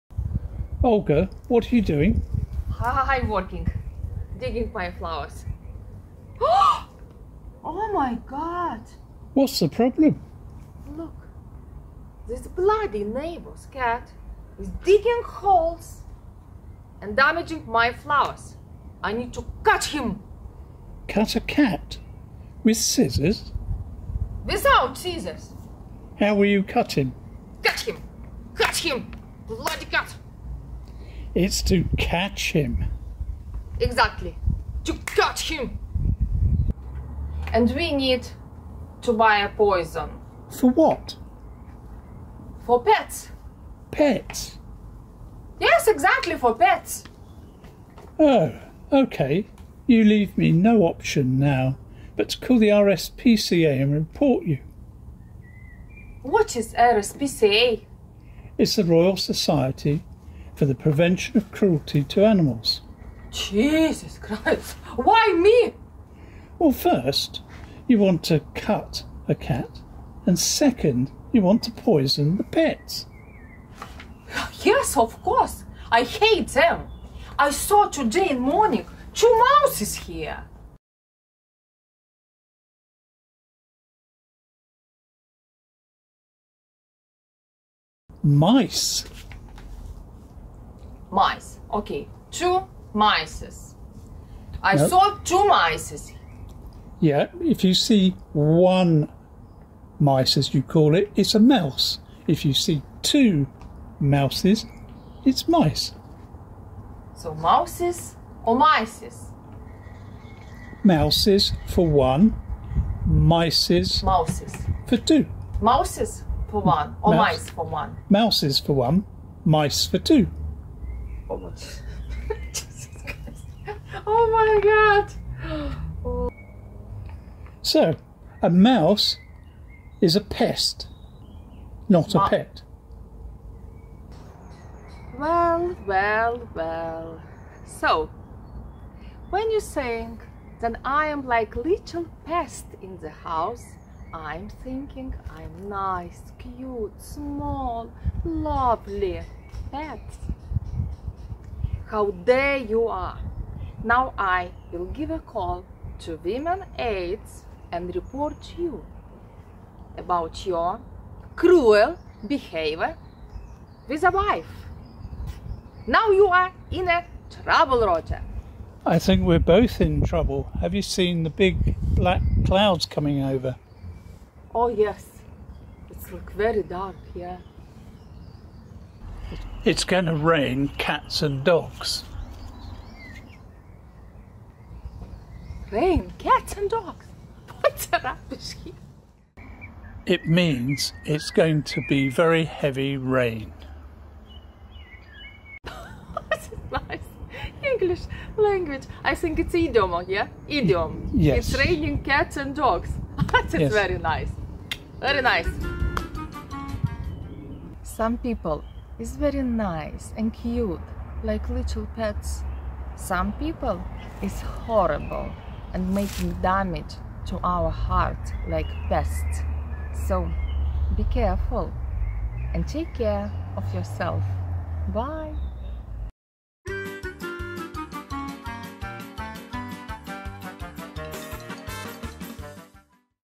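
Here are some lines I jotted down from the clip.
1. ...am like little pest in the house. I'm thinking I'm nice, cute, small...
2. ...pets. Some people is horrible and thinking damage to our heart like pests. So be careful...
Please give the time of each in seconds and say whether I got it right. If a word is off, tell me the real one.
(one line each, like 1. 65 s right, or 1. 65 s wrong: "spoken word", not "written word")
1. 141 s right
2. 211 s wrong: "making", not "thinking".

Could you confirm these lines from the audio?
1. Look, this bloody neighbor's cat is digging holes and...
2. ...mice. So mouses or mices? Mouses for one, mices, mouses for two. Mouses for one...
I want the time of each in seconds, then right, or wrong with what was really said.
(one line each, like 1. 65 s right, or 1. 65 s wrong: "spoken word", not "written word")
1. 10 s right
2. 105 s right.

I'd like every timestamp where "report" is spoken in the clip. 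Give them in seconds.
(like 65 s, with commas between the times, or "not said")
53 s, 157 s.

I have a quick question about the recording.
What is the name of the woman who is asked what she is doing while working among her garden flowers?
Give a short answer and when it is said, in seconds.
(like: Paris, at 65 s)
Olga, at 0 s.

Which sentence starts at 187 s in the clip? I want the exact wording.
What's that It means it's going to be very heavy rain.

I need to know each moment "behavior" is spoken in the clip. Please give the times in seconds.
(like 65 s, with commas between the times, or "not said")
162 s.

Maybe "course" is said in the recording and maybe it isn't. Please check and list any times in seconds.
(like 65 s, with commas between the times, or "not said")
75 s.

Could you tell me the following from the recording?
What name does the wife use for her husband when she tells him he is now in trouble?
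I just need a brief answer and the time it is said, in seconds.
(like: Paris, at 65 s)
Roger, at 167 s.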